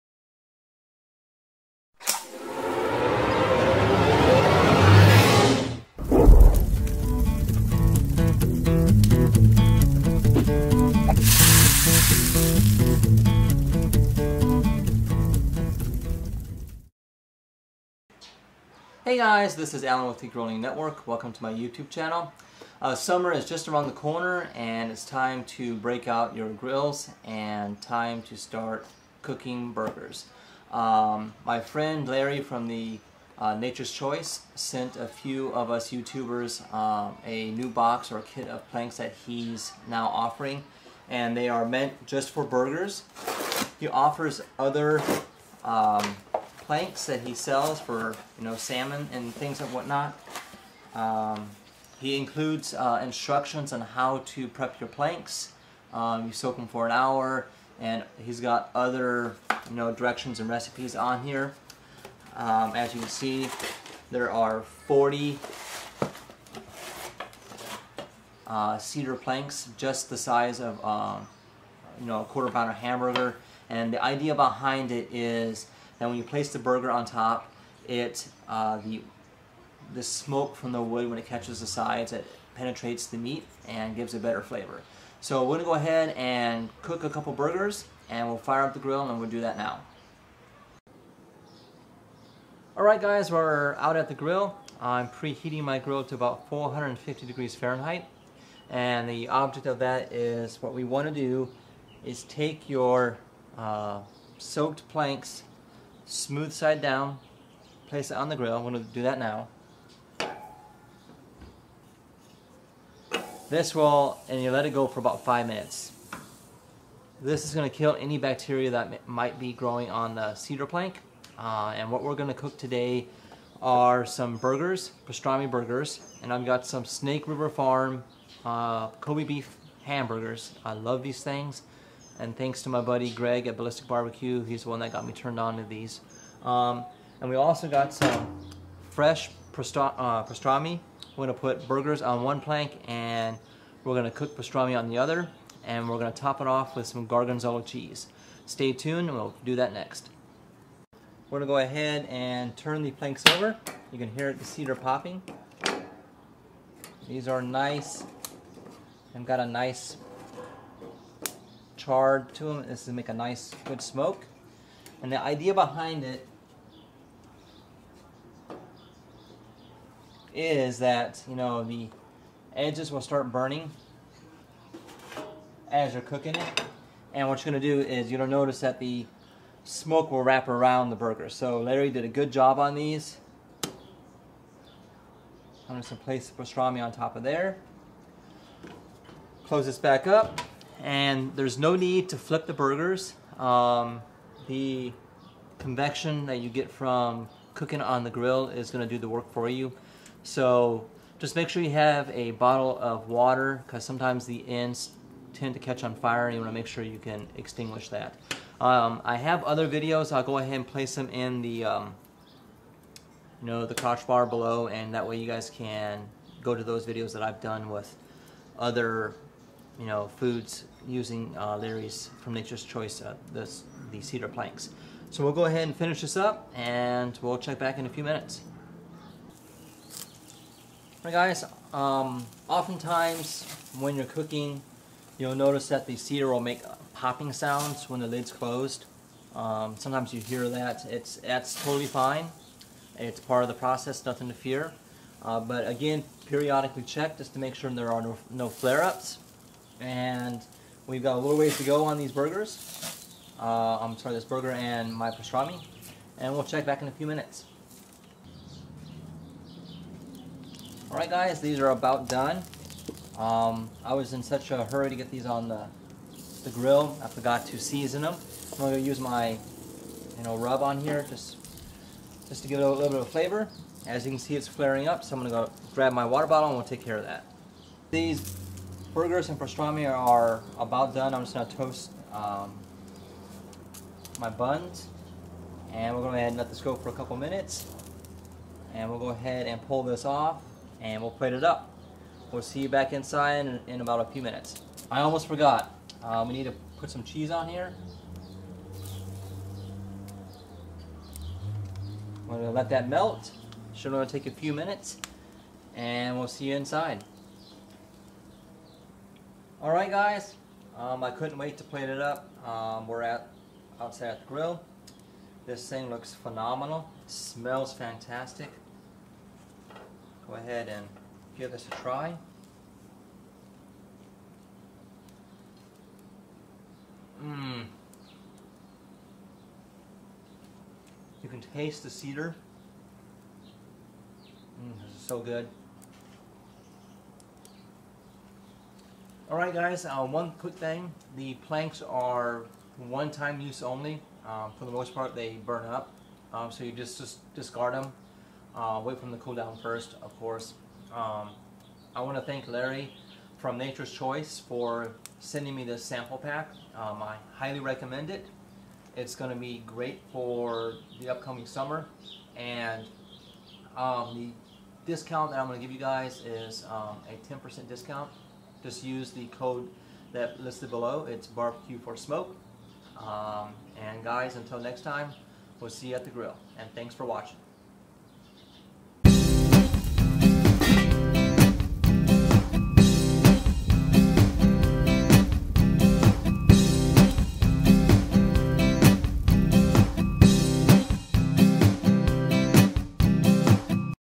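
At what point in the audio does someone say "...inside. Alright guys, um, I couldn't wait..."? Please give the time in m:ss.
5:06.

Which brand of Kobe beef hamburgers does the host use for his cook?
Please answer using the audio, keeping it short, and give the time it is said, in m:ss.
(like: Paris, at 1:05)
Snake River Farm, at 2:06.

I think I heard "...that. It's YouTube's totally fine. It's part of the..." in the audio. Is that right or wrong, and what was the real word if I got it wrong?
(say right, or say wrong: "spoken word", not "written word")
wrong: "That", not "YouTube".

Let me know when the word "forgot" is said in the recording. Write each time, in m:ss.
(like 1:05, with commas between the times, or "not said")
4:27, 4:55.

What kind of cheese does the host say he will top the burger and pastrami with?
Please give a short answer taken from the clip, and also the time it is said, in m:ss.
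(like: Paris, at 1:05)
Gorgonzola, at 2:27.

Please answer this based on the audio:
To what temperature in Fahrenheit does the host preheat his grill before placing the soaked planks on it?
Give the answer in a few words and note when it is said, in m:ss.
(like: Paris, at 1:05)
450 degrees, at 1:36.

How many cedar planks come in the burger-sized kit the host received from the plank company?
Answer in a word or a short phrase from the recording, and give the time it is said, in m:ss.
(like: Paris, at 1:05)
40, at 1:04.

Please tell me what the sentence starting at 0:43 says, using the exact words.
He offers other um, planks that he sells for you know salmon and things and whatnot.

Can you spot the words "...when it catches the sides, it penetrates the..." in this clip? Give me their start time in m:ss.
1:21.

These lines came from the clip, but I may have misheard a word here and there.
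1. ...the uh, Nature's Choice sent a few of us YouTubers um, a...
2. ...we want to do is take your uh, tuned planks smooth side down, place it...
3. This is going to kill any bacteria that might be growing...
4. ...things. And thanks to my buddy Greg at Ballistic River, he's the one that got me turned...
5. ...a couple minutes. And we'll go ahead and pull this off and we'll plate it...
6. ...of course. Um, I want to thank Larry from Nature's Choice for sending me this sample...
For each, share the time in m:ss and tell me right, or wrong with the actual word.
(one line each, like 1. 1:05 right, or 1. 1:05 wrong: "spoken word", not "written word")
1. 0:32 right
2. 1:40 wrong: "soaked", not "tuned"
3. 1:57 right
4. 2:11 wrong: "Barbecue", not "River"
5. 4:46 right
6. 5:50 right.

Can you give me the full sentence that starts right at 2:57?
And what you're gonna do is you'll notice that the smoke will wrap around the burger.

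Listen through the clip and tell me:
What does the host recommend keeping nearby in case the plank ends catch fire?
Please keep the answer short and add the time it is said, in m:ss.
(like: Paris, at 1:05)
A bottle of water, at 3:22.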